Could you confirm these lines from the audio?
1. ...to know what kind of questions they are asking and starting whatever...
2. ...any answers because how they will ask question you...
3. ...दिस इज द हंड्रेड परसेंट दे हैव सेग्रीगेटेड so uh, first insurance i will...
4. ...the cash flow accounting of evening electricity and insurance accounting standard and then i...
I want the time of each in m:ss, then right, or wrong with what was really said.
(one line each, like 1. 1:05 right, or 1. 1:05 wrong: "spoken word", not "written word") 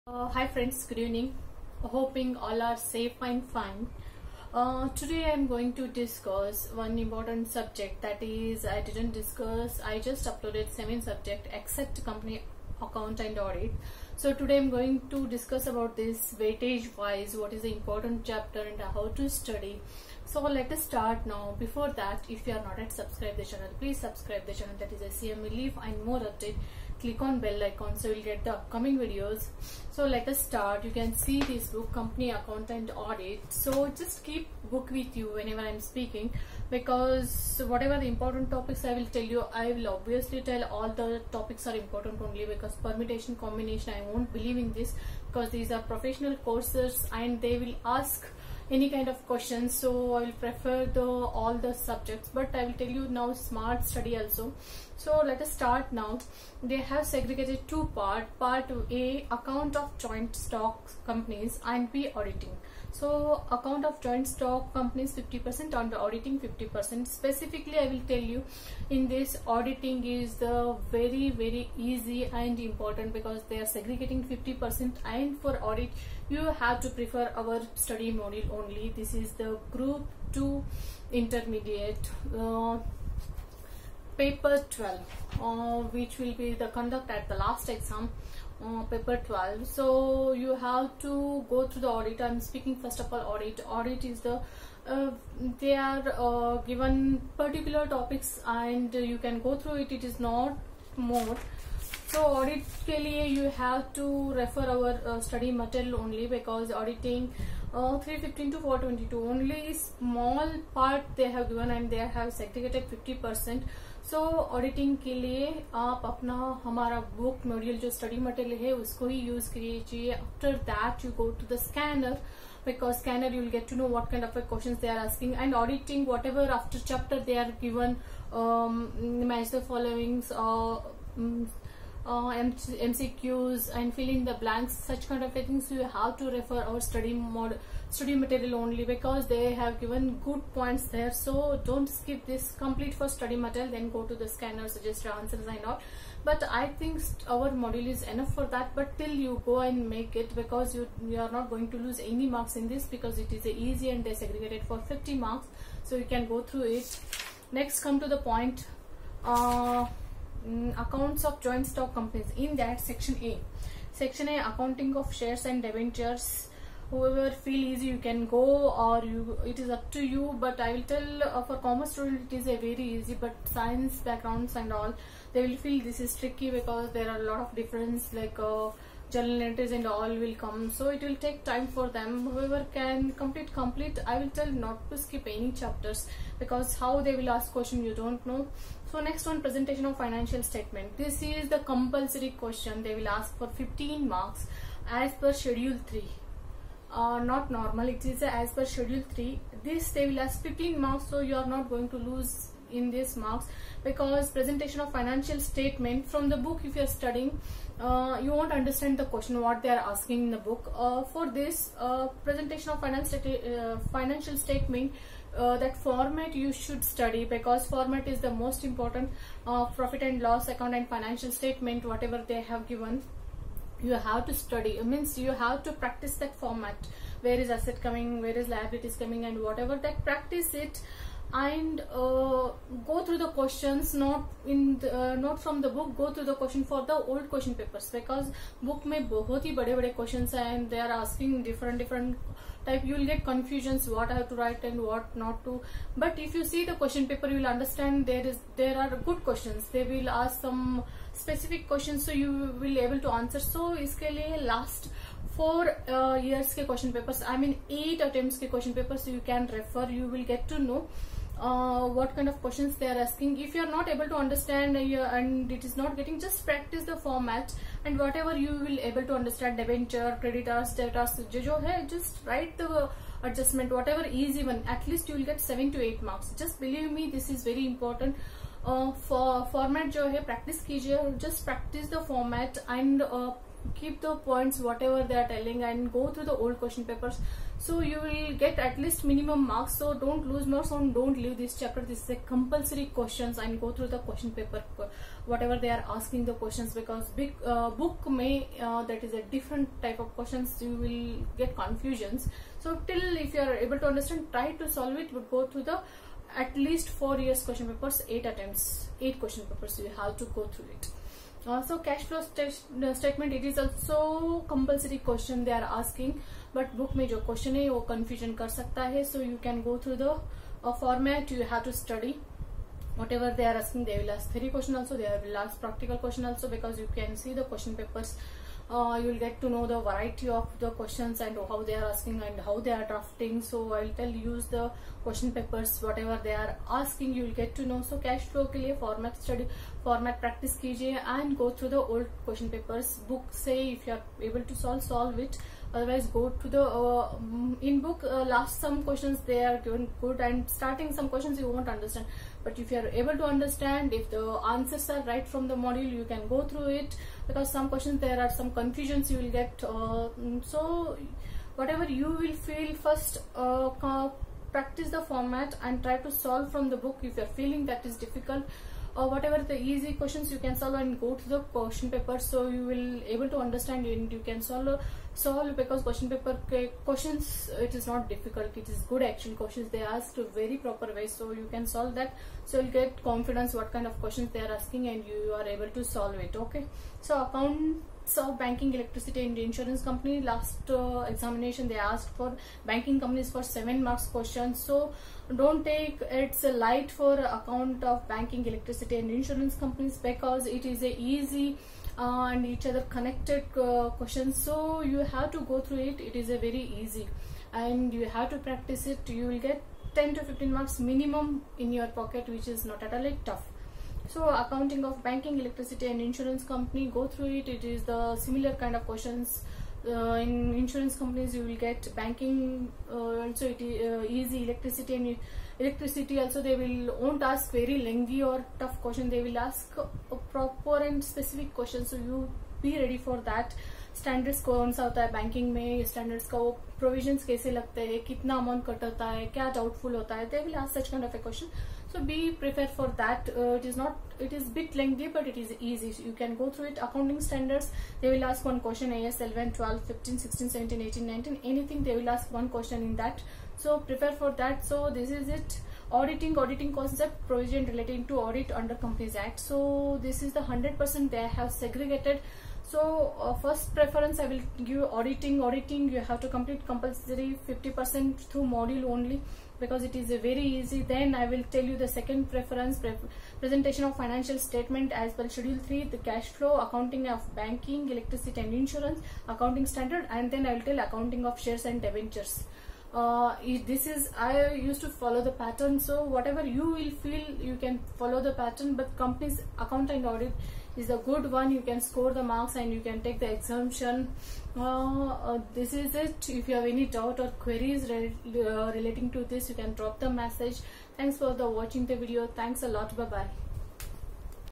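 1. 2:03 wrong: "auditing", not "starting"
2. 3:05 wrong: "chapters", not "answers"
3. 7:40 wrong: "preference", not "insurance"
4. 7:55 wrong: "banking", not "evening".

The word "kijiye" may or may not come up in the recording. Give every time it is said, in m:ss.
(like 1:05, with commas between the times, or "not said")
4:40, 5:40.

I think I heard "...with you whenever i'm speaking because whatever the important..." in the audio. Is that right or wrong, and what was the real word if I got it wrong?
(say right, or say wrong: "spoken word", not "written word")
right.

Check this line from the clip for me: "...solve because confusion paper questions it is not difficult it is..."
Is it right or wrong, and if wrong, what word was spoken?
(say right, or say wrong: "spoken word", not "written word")
wrong: "question", not "confusion".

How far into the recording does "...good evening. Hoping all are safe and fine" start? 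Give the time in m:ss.
0:00.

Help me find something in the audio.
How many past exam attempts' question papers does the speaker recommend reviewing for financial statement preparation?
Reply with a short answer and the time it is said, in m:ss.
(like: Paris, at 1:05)
8, at 5:08.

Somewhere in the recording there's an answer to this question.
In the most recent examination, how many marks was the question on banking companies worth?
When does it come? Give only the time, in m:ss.
6:33.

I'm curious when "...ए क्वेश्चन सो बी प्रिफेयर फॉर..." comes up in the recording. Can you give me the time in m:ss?
7:21.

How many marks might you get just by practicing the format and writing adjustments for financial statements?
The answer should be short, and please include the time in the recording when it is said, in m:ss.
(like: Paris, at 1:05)
7 to 8, at 4:35.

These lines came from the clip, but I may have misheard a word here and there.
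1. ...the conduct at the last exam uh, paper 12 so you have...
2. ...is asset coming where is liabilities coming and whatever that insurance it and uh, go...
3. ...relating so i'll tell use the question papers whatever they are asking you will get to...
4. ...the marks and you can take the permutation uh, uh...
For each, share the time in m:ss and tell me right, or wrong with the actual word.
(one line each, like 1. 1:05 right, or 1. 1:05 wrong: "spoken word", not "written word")
1. 1:26 right
2. 3:47 wrong: "practice", not "insurance"
3. 5:32 wrong: "drafting", not "relating"
4. 8:12 wrong: "exemption", not "permutation".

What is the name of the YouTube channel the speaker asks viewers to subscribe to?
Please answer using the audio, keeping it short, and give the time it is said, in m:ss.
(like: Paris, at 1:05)
CMA leaf, at 0:25.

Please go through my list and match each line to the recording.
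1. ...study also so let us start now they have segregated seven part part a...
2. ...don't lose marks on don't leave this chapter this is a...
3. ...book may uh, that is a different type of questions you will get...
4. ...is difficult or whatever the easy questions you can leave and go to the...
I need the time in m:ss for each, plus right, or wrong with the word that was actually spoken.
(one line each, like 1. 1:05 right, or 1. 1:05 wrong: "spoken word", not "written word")
1. 0:53 wrong: "two", not "seven"
2. 4:49 right
3. 4:57 right
4. 6:07 wrong: "solve", not "leave".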